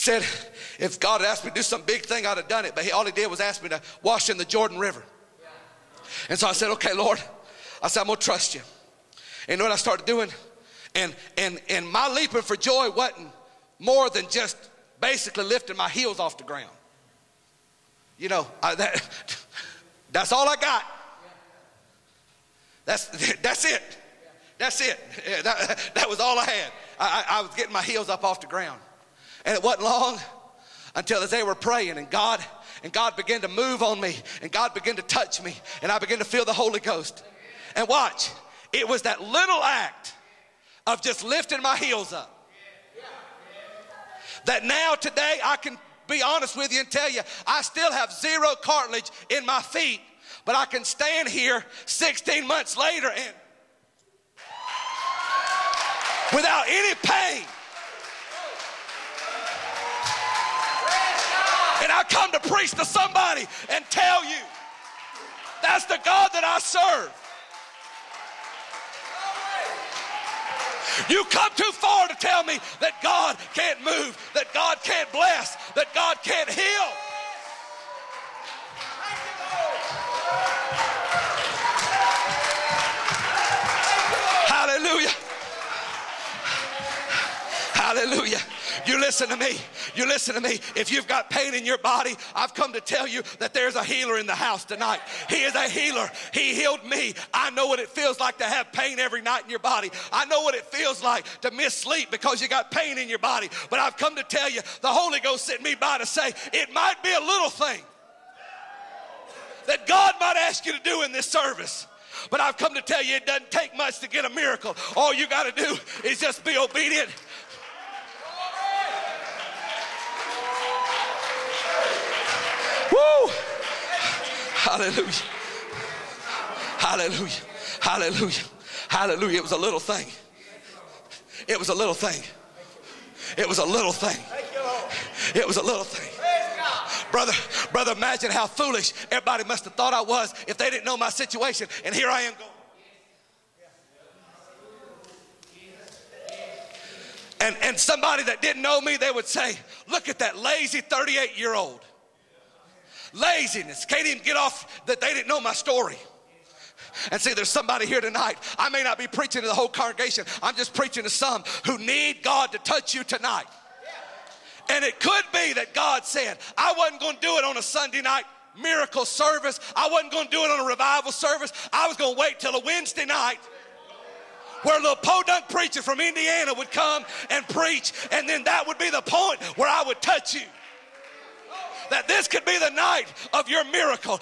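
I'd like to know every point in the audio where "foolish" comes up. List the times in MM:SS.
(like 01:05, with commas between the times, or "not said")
02:18.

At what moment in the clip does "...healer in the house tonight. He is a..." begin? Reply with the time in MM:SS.
01:33.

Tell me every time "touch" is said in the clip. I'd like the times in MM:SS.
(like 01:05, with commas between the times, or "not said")
00:35, 02:42, 03:00.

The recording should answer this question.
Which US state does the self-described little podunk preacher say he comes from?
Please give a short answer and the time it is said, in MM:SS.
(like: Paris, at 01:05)
Indiana, at 02:56.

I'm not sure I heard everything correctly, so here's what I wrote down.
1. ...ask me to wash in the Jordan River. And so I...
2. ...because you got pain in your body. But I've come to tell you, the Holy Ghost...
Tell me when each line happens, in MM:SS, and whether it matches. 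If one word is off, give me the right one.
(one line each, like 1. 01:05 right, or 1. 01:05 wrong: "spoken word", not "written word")
1. 00:03 right
2. 01:42 right.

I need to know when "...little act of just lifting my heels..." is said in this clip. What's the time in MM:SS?
00:39.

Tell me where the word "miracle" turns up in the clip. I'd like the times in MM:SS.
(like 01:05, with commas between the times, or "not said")
01:54, 02:48, 03:03.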